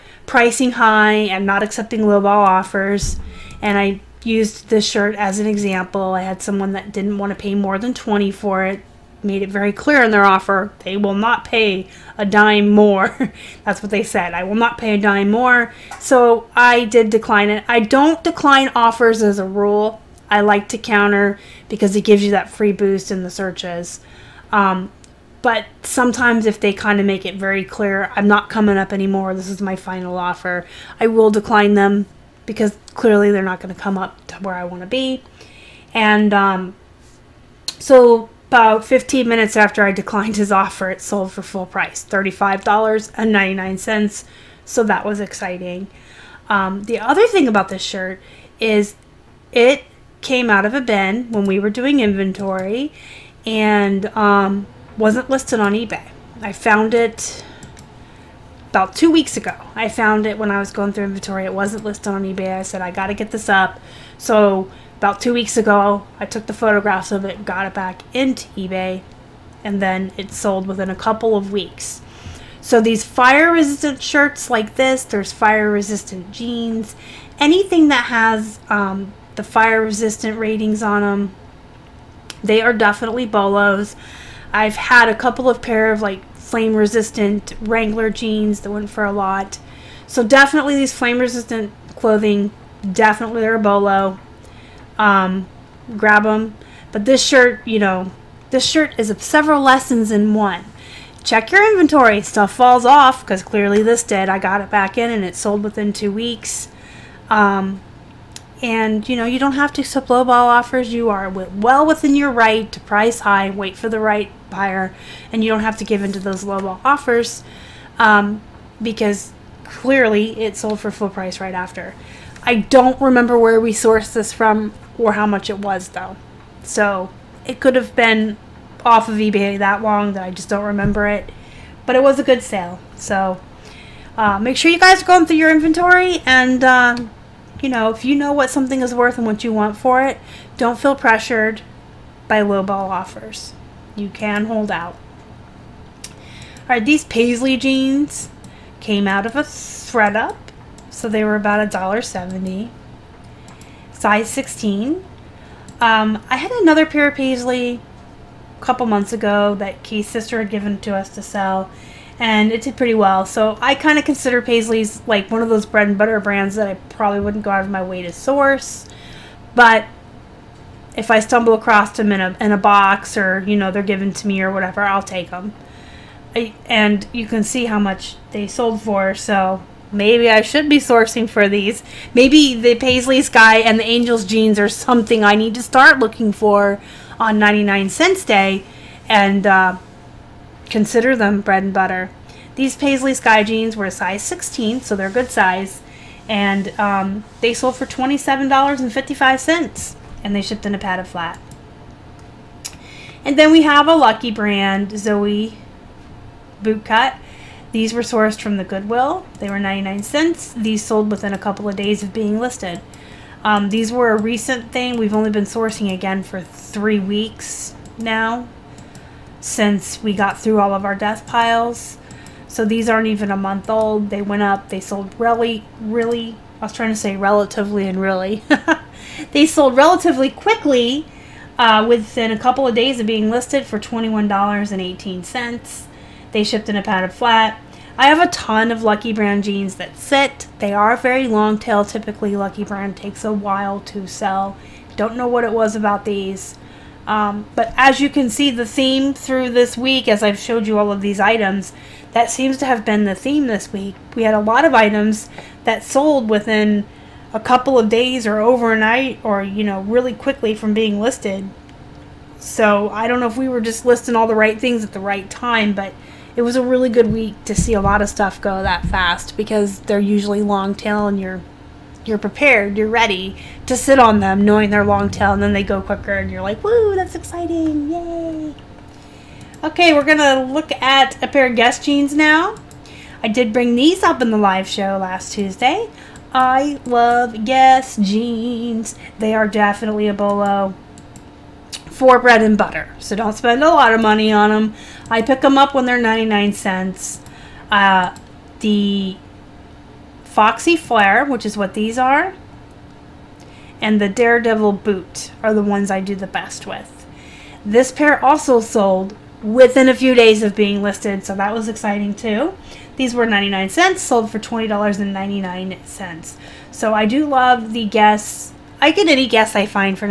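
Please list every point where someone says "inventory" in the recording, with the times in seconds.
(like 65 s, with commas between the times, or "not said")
52 s, 61 s, 101 s, 135 s.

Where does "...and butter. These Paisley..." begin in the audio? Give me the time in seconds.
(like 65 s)
191 s.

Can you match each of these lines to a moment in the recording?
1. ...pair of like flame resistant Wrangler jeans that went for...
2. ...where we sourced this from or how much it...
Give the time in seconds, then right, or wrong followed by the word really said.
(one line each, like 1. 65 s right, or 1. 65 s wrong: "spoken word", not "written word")
1. 85 s right
2. 123 s right.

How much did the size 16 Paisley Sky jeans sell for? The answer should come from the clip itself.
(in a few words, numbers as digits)
$27.55.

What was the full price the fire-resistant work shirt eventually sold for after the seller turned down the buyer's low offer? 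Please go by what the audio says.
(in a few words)
$35.99.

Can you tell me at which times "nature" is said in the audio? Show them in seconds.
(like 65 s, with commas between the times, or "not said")
not said.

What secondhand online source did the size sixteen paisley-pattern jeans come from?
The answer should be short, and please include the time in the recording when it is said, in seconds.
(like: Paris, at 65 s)
ThredUP, at 149 s.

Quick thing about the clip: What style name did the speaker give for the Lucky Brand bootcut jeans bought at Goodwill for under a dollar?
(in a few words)
Zoe Bootcut.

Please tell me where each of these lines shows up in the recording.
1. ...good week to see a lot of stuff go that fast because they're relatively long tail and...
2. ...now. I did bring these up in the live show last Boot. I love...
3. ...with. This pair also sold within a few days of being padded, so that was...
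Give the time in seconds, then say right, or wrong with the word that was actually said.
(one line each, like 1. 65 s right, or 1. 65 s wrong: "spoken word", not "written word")
1. 266 s wrong: "usually", not "relatively"
2. 282 s wrong: "Tuesday", not "Boot"
3. 306 s wrong: "listed", not "padded".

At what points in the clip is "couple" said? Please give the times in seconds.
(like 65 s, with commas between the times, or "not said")
70 s, 85 s, 158 s, 211 s, 232 s, 257 s.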